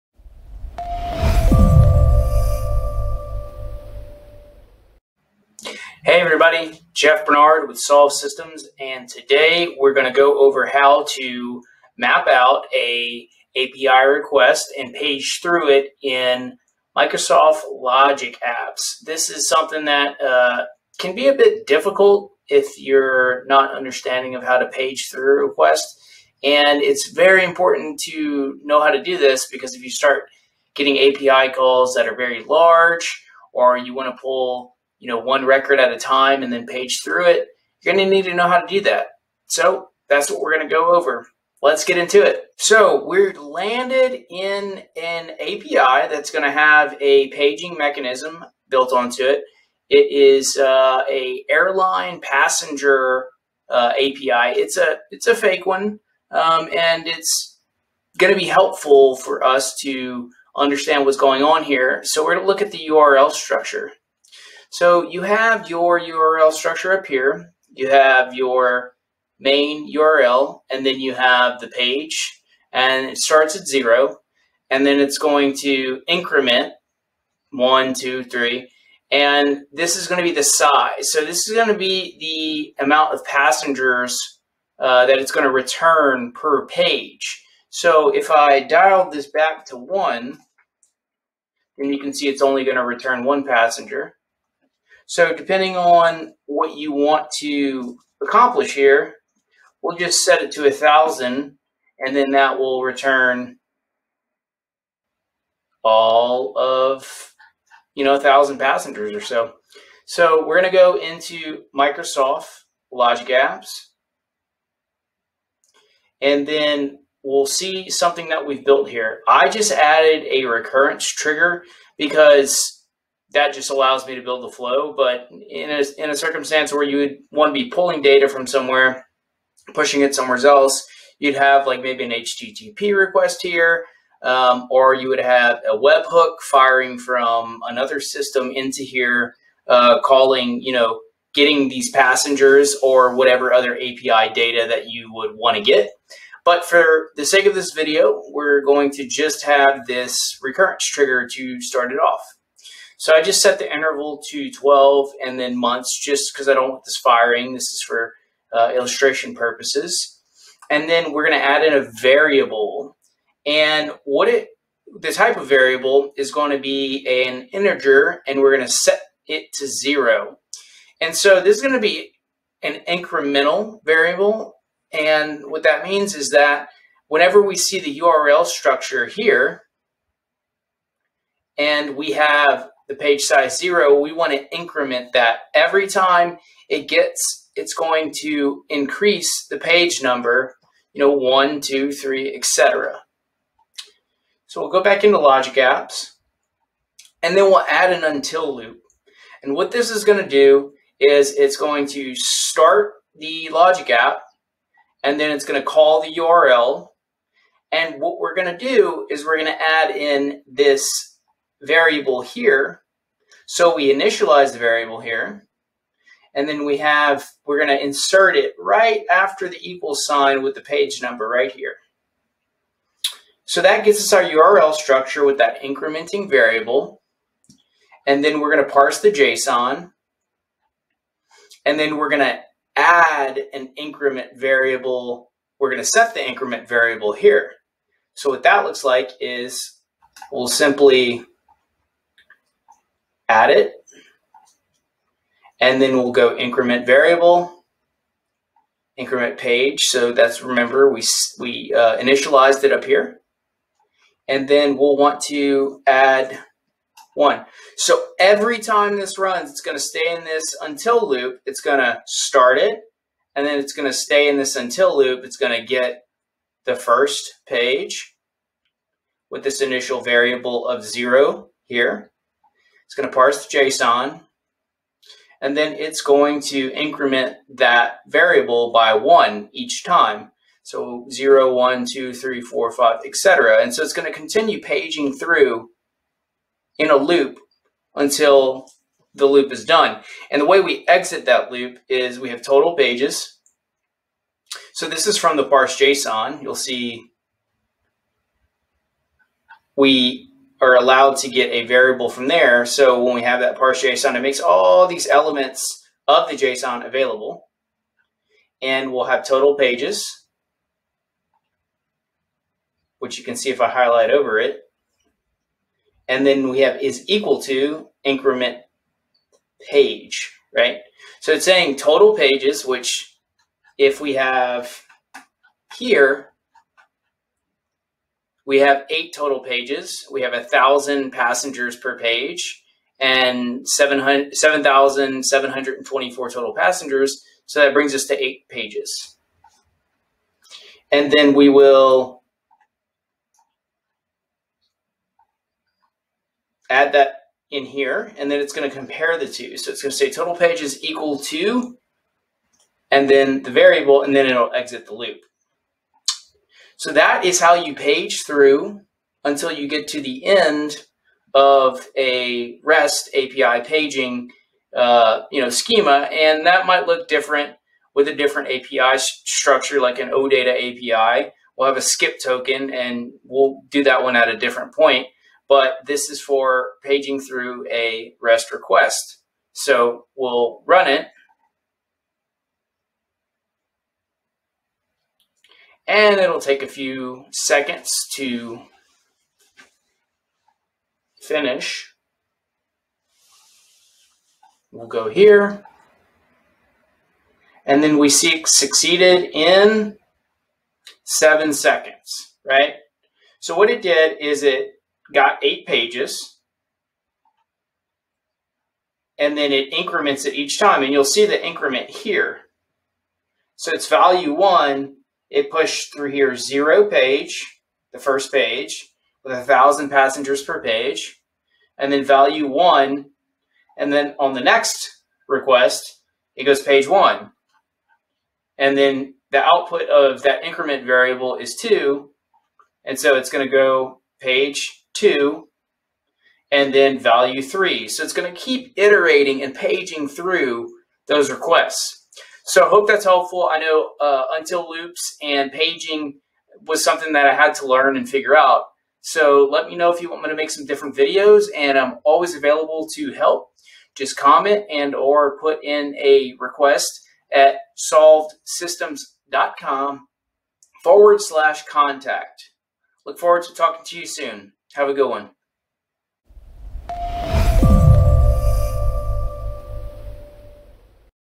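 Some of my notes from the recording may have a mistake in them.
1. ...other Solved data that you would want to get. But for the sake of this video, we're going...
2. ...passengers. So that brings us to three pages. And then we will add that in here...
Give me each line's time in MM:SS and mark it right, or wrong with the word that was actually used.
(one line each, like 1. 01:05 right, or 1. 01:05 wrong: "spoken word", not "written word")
1. 02:23 wrong: "API", not "Solved"
2. 05:36 wrong: "eight", not "three".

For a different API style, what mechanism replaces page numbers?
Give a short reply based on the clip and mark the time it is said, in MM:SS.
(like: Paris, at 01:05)
Skip token, at 06:11.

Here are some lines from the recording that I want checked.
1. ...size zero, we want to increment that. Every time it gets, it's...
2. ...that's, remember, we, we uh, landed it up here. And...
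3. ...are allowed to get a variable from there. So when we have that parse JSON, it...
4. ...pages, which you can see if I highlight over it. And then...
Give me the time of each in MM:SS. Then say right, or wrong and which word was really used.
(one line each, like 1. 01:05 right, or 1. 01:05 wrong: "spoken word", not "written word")
1. 03:03 right
2. 04:10 wrong: "initialized", not "landed"
3. 05:00 right
4. 05:09 right.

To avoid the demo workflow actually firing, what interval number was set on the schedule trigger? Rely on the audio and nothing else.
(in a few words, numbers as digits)
12.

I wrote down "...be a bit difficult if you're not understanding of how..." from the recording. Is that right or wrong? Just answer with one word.
right.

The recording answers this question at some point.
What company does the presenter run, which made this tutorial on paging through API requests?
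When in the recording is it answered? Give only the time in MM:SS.
00:07.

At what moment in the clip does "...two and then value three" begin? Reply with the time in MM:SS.
07:14.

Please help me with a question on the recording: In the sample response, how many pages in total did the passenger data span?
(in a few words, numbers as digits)
8.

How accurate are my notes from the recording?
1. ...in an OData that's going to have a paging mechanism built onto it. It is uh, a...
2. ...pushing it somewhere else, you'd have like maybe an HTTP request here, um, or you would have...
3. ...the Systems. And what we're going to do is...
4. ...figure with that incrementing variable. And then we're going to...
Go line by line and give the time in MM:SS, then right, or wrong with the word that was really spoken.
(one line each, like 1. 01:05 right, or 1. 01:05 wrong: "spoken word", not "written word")
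1. 00:44 wrong: "API", not "OData"
2. 02:09 right
3. 03:26 wrong: "URL", not "Systems"
4. 03:44 wrong: "structure", not "figure".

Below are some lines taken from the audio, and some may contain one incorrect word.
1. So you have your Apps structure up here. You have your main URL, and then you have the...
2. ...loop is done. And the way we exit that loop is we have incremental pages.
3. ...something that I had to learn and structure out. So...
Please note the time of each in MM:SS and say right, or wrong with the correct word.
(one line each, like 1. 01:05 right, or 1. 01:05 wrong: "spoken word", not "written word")
1. 01:04 wrong: "URL", not "Apps"
2. 04:49 wrong: "total", not "incremental"
3. 07:26 wrong: "figure", not "structure".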